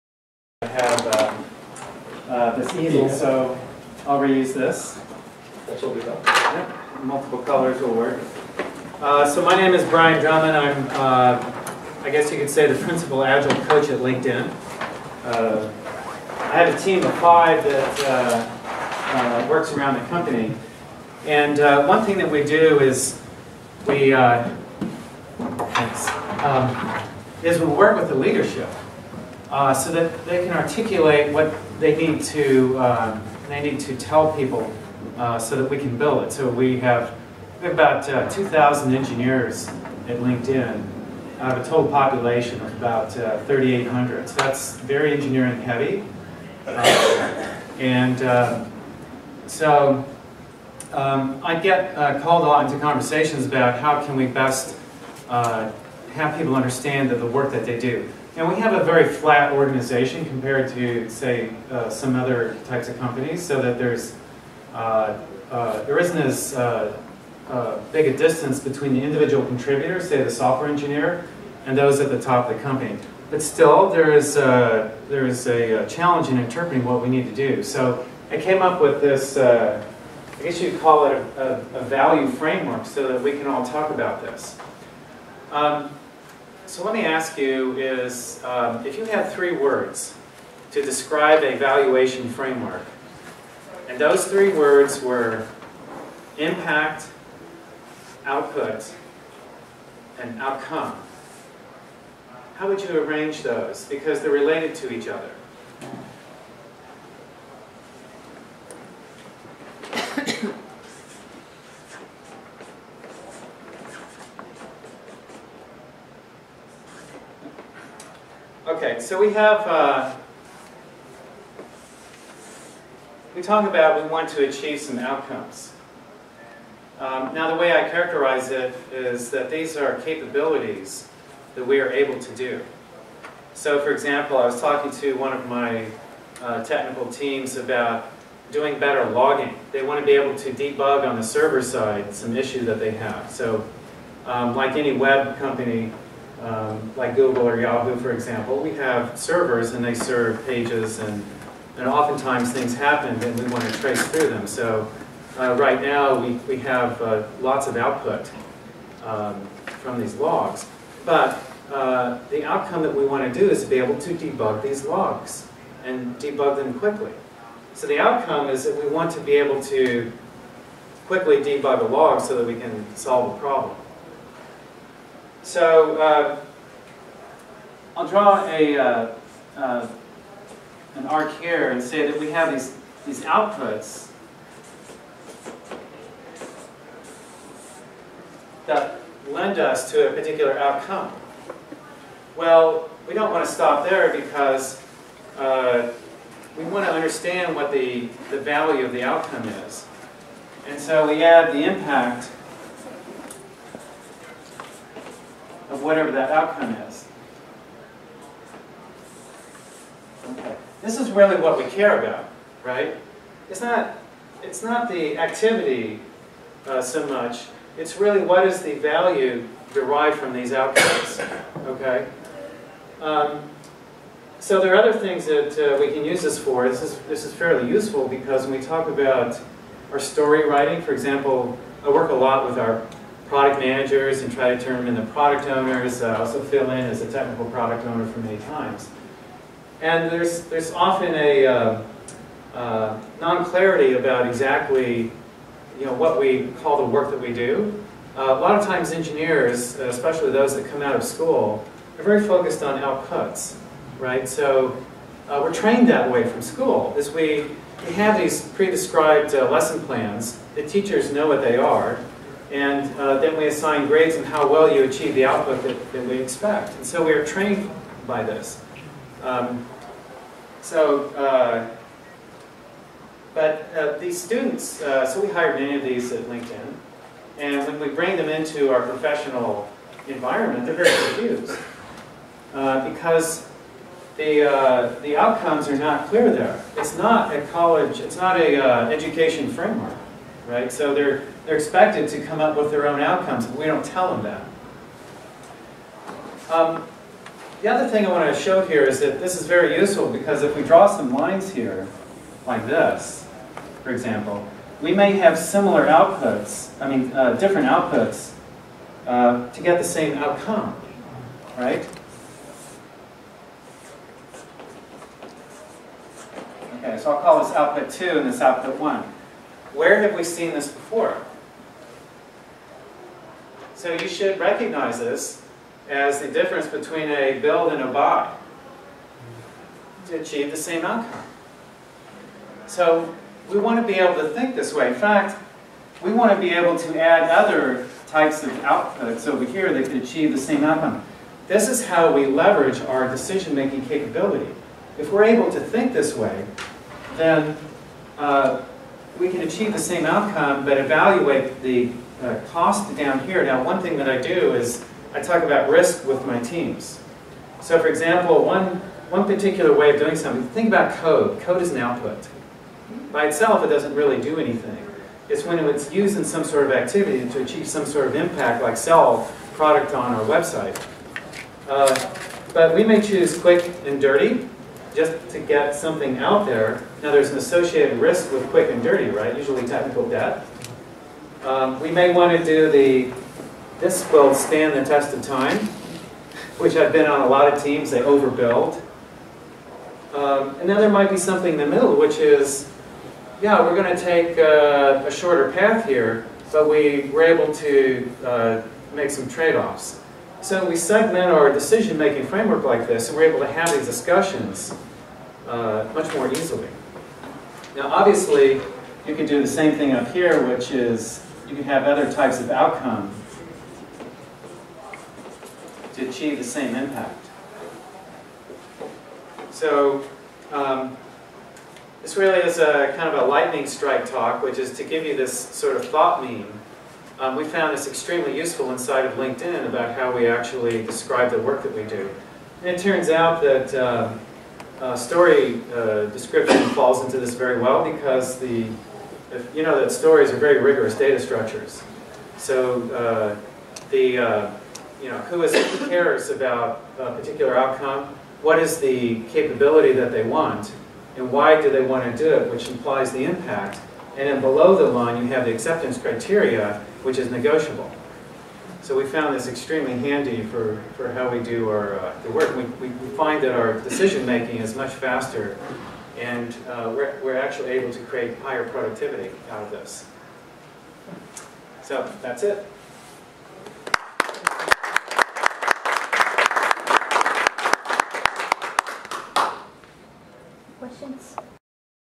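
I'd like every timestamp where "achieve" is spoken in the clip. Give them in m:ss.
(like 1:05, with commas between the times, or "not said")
2:04, 4:24, 5:30, 5:40, 5:49, 6:07, 6:56.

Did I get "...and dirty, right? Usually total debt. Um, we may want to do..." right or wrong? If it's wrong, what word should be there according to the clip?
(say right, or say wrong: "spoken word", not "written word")
wrong: "technical", not "total".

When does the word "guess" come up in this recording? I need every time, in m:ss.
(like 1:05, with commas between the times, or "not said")
0:12, 1:20.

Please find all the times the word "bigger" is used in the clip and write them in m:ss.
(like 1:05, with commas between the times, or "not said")
not said.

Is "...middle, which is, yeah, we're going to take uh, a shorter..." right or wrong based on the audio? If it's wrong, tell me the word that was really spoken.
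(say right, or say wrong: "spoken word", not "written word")
right.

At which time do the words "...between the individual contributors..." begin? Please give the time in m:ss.
1:08.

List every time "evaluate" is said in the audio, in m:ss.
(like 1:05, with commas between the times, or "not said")
5:50.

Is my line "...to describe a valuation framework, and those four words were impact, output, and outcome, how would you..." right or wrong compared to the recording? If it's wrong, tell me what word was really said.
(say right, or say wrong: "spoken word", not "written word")
wrong: "three", not "four".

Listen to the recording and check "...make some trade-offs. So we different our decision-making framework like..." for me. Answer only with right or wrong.
wrong.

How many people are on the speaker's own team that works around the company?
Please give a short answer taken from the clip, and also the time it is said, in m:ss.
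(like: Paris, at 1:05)
5, at 0:17.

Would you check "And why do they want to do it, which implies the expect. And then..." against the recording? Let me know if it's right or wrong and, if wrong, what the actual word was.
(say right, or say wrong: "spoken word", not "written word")
wrong: "impact", not "expect".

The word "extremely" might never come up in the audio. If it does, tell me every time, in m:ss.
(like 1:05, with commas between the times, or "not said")
7:07, 7:39.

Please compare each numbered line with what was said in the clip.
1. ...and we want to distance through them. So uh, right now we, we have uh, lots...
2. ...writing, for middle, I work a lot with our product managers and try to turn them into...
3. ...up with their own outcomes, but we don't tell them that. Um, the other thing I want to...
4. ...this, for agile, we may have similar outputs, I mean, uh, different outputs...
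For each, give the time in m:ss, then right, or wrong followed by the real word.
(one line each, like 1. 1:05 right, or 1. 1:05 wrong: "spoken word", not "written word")
1. 2:33 wrong: "trace", not "distance"
2. 3:50 wrong: "example", not "middle"
3. 4:52 right
4. 5:02 wrong: "example", not "agile".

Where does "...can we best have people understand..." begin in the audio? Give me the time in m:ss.
0:54.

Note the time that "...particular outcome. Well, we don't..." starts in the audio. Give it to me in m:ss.
3:10.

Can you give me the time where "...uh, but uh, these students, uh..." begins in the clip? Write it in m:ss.
4:31.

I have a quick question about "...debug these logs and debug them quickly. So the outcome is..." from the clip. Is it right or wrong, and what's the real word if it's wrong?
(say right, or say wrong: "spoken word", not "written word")
right.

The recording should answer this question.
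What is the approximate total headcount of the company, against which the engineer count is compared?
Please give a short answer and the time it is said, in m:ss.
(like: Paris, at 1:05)
3,800, at 0:43.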